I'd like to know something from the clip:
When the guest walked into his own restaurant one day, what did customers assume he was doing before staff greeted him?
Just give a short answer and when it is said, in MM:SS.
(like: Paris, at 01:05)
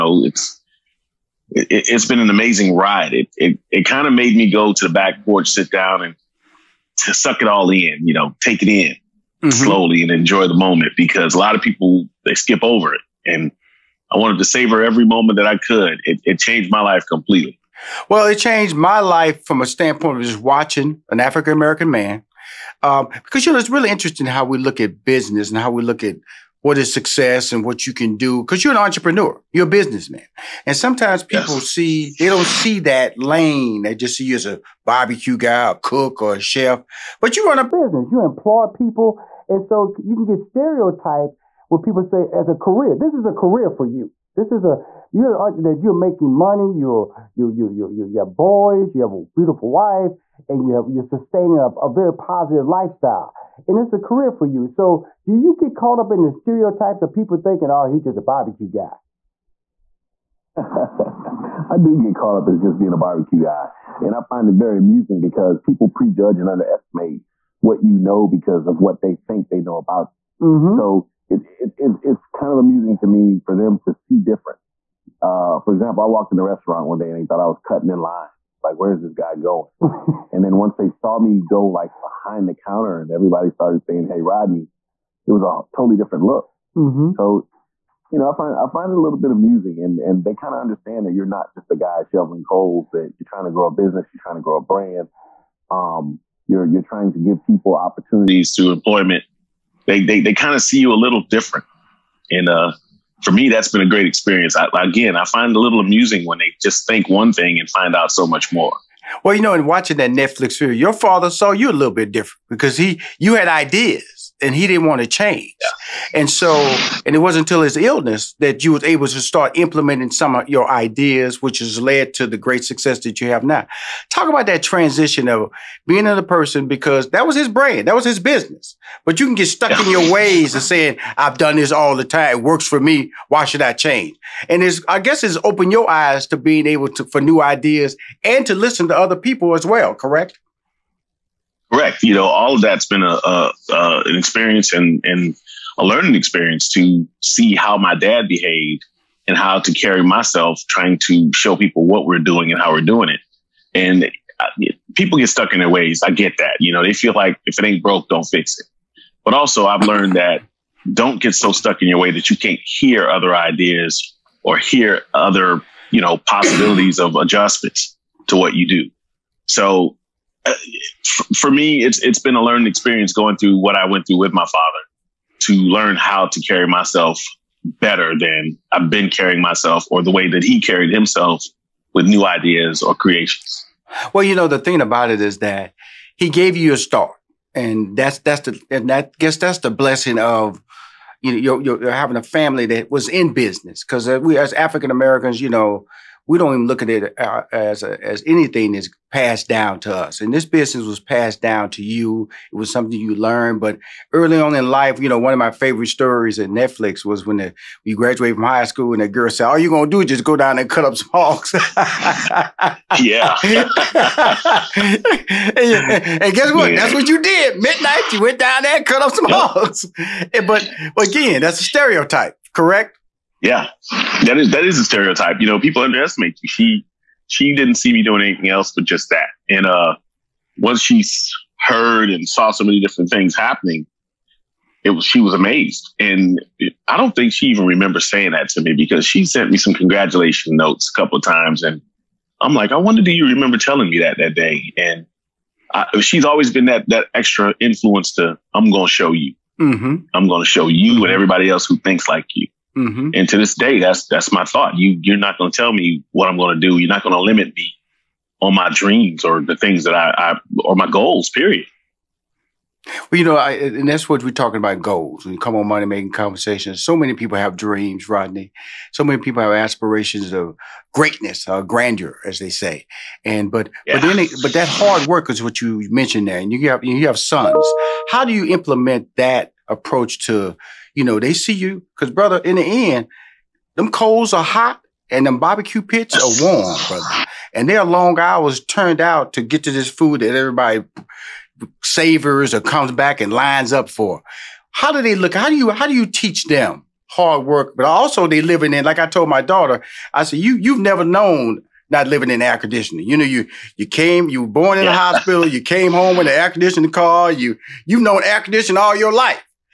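Cutting in line, at 01:17.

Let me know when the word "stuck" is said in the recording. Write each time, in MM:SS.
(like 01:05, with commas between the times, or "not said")
02:09, 02:35, 02:41.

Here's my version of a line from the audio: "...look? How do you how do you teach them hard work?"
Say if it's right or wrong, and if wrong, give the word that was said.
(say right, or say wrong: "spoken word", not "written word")
right.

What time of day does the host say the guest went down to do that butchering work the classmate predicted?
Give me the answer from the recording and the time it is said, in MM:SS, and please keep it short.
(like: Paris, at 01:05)
Midnight, at 03:37.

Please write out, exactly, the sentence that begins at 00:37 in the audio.
But you run a business, you employ people.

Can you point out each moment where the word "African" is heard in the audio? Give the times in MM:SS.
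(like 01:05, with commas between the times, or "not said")
00:21, 03:14.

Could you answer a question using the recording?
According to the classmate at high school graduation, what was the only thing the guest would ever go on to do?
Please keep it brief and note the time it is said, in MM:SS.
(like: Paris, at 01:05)
Cut up some hogs, at 03:30.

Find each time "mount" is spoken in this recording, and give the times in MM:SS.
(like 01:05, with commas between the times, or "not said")
not said.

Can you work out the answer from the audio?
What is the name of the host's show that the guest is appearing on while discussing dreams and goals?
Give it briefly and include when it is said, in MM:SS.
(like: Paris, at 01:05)
Money Making Conversations, at 04:25.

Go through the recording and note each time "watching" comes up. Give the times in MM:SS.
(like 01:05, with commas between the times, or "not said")
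00:20, 01:49.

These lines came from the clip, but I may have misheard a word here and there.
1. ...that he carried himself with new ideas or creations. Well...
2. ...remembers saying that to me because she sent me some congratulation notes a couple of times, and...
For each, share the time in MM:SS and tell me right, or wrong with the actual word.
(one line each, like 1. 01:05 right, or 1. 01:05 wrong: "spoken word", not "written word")
1. 03:00 right
2. 03:57 right.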